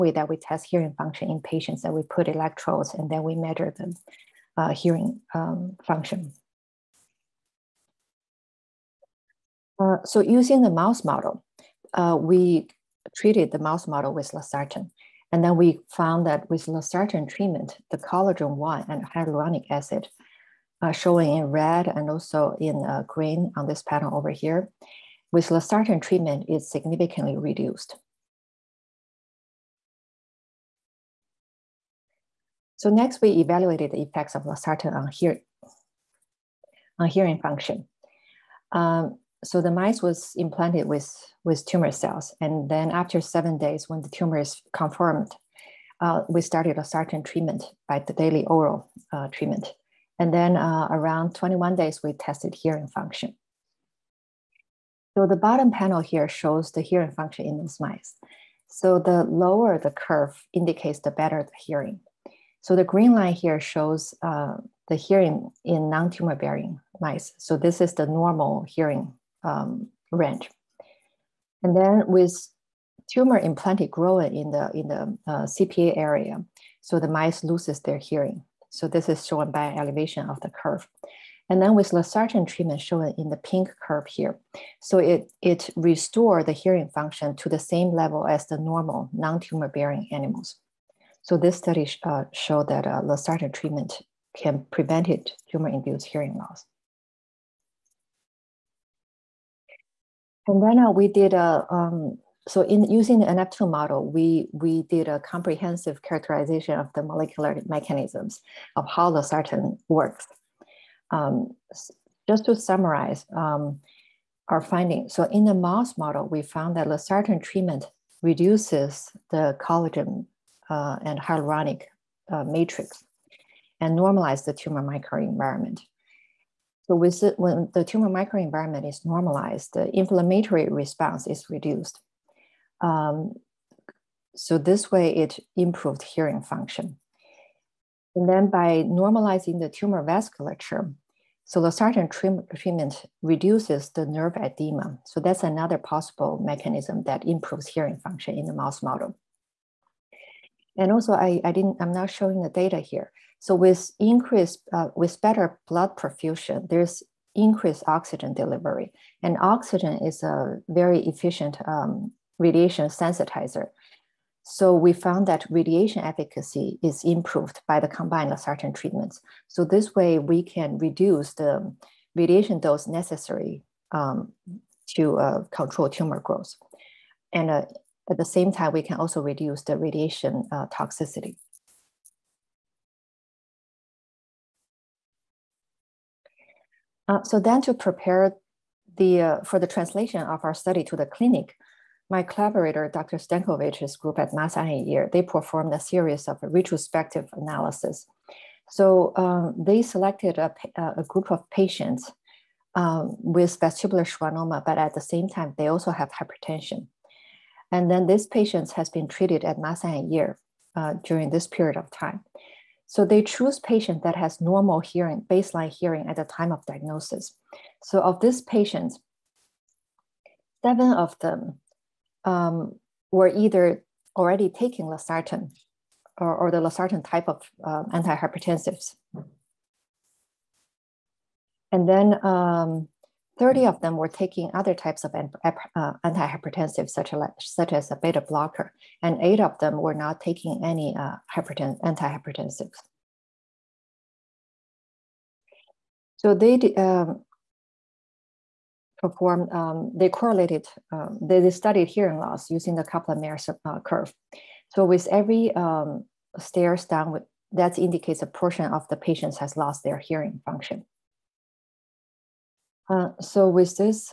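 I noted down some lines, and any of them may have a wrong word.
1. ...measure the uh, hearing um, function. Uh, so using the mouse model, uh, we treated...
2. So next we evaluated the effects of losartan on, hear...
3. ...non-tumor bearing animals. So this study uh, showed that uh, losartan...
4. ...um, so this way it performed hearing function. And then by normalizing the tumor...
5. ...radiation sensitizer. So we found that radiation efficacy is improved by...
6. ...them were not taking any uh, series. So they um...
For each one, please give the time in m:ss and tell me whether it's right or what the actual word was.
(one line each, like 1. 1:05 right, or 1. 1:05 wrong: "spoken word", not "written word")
1. 0:03 right
2. 0:32 right
3. 1:29 right
4. 2:12 wrong: "improved", not "performed"
5. 2:42 right
6. 3:59 wrong: "antihypertensives", not "series".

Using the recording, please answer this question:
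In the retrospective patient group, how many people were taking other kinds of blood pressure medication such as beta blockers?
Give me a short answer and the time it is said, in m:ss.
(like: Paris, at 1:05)
30, at 3:53.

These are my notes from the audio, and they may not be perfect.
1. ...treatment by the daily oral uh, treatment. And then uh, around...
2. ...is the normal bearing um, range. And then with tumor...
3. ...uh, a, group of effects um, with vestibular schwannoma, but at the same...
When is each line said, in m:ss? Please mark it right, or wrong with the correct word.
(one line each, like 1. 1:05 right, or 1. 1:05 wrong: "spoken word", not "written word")
1. 0:47 right
2. 1:07 wrong: "hearing", not "bearing"
3. 3:20 wrong: "patients", not "effects".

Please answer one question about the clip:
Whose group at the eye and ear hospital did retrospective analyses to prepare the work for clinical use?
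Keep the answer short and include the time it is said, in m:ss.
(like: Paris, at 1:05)
Dr. Stankovic, at 3:12.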